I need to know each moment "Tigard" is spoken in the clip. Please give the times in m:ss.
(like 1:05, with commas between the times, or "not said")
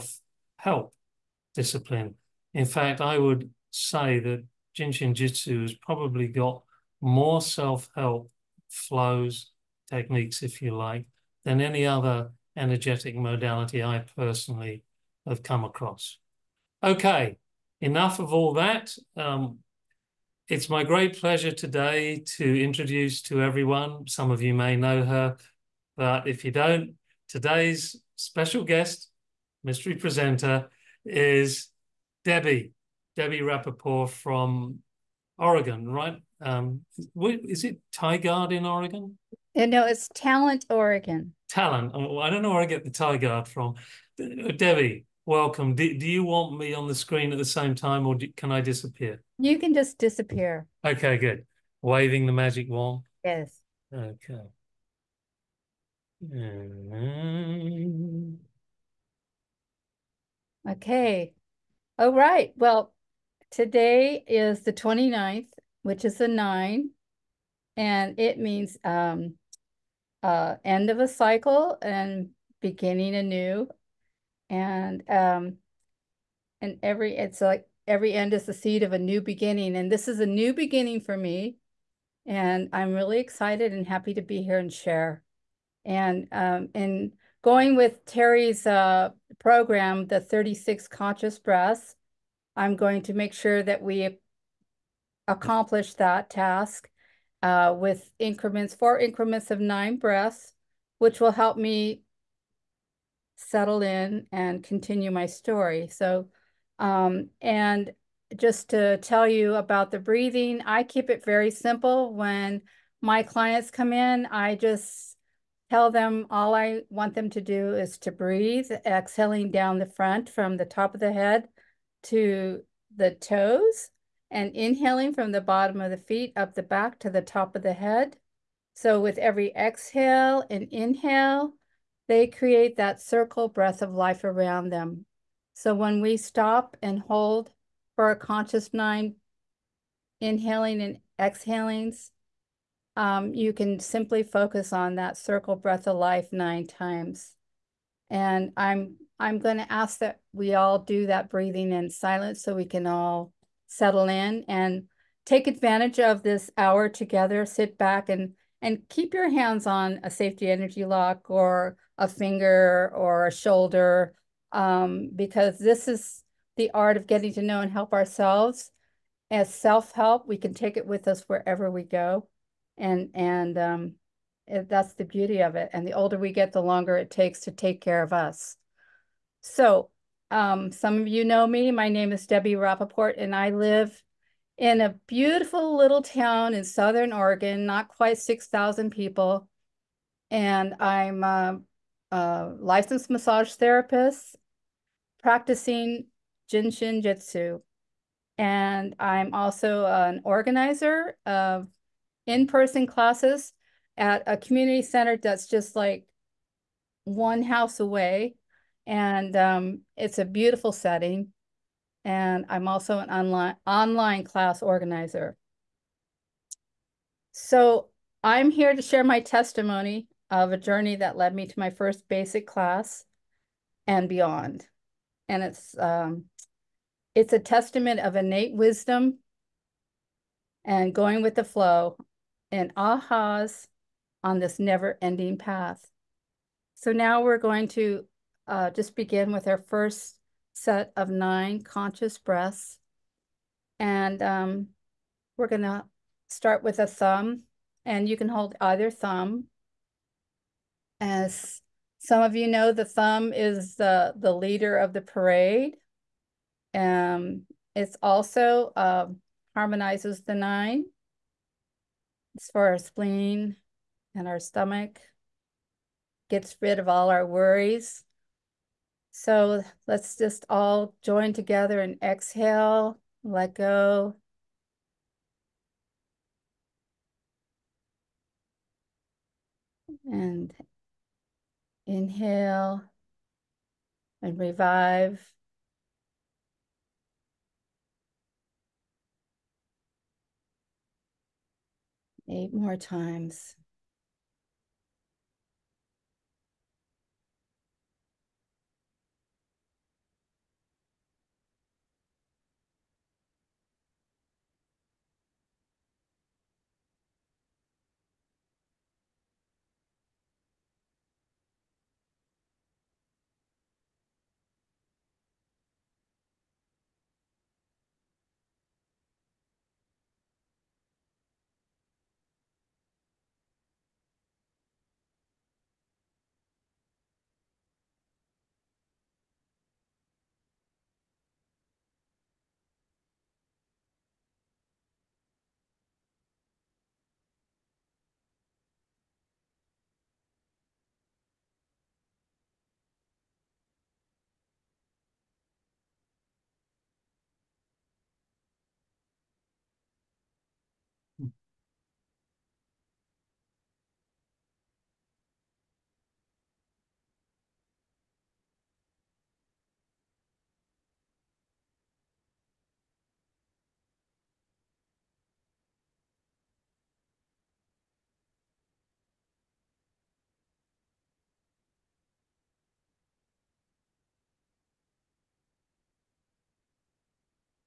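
0:37, 0:42.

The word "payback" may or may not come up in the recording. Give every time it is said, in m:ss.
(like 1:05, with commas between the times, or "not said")
not said.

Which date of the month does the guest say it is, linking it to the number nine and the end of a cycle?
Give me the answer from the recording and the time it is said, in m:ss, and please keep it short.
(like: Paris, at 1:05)
29th, at 1:04.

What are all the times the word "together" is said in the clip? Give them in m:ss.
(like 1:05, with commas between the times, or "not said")
2:36, 4:31.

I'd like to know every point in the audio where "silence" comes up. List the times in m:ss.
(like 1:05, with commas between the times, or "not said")
2:31.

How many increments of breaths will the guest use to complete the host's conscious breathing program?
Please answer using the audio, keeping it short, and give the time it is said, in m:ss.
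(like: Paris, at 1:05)
4, at 1:38.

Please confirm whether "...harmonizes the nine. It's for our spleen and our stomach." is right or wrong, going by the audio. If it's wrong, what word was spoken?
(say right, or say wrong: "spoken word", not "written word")
right.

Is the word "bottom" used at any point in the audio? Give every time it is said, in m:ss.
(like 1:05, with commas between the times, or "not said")
2:05.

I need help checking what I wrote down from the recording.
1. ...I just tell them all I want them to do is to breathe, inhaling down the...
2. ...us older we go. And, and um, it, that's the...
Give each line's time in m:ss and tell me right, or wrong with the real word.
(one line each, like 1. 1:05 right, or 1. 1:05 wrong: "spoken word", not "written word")
1. 1:54 wrong: "exhaling", not "inhaling"
2. 2:51 wrong: "wherever", not "older".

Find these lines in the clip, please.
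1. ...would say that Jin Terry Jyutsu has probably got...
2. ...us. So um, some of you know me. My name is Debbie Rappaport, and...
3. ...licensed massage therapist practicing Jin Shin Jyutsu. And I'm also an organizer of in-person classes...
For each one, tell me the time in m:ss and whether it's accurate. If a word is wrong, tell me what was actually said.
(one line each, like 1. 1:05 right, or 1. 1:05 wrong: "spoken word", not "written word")
1. 0:03 wrong: "Shin", not "Terry"
2. 2:58 right
3. 3:12 right.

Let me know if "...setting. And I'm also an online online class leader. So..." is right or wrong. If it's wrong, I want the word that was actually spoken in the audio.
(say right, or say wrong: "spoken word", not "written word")
wrong: "organizer", not "leader".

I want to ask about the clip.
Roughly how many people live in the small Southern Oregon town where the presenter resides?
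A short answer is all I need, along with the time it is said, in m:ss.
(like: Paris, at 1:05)
Not quite 6,000, at 3:07.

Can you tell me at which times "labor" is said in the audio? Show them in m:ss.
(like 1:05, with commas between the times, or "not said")
not said.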